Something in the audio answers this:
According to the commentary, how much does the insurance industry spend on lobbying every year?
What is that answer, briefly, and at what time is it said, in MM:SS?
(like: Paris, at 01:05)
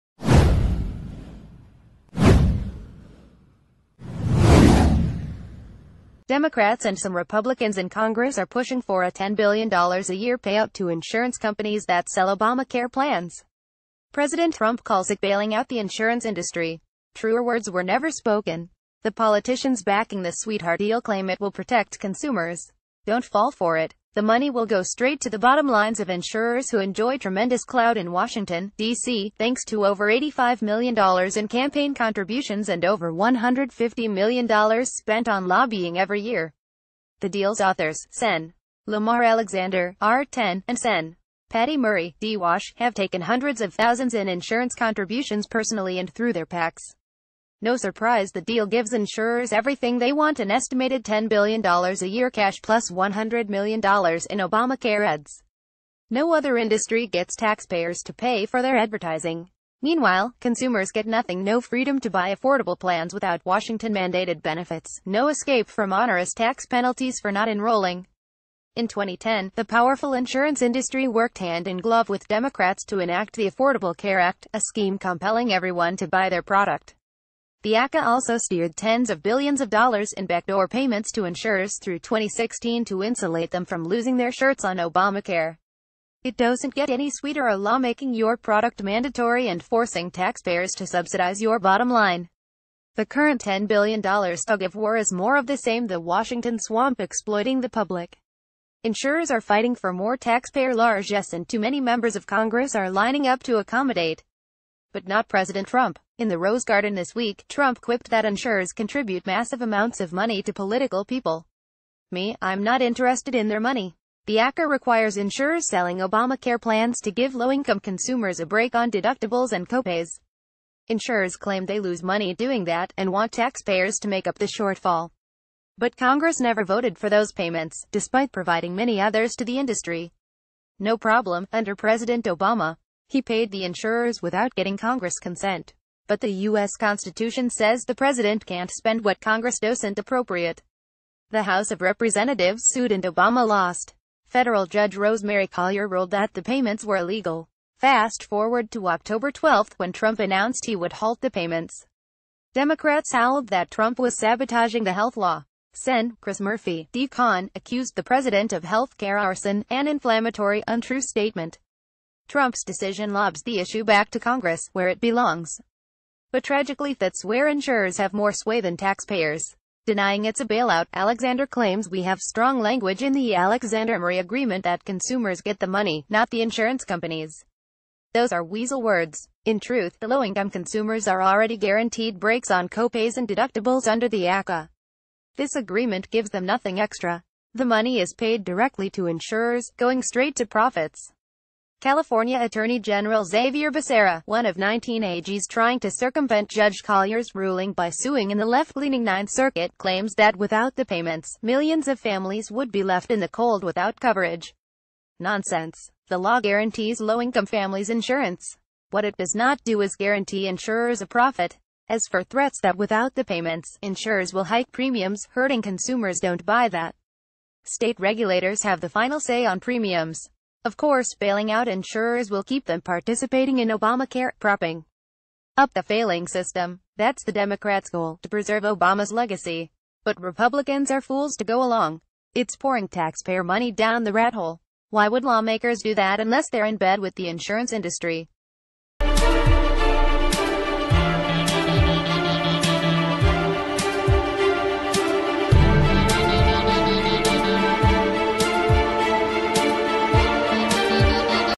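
Over $150 million, at 00:32.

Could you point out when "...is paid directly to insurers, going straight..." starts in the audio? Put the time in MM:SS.
03:07.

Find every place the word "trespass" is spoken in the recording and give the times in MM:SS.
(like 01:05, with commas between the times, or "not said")
not said.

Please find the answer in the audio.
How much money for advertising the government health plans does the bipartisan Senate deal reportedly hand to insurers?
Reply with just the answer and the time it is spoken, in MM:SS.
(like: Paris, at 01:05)
$100 million, at 00:52.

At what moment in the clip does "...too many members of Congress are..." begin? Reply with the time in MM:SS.
01:41.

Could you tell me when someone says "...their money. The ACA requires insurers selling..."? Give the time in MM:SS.
01:53.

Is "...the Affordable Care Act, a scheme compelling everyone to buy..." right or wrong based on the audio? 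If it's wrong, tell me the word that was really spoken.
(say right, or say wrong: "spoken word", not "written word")
right.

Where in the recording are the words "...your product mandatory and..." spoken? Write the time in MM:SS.
01:28.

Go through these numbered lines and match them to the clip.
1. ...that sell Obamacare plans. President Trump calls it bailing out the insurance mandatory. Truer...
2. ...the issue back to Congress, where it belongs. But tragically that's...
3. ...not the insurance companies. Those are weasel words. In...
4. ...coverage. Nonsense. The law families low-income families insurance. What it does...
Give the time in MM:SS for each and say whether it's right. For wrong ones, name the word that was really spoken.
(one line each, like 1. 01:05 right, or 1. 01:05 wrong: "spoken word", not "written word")
1. 00:11 wrong: "industry", not "mandatory"
2. 02:43 right
3. 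02:56 right
4. 03:23 wrong: "guarantees", not "families".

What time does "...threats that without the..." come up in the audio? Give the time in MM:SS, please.
03:32.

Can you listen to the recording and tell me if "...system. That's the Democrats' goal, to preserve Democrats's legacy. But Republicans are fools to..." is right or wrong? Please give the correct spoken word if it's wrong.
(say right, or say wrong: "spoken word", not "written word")
wrong: "Obama", not "Democrats".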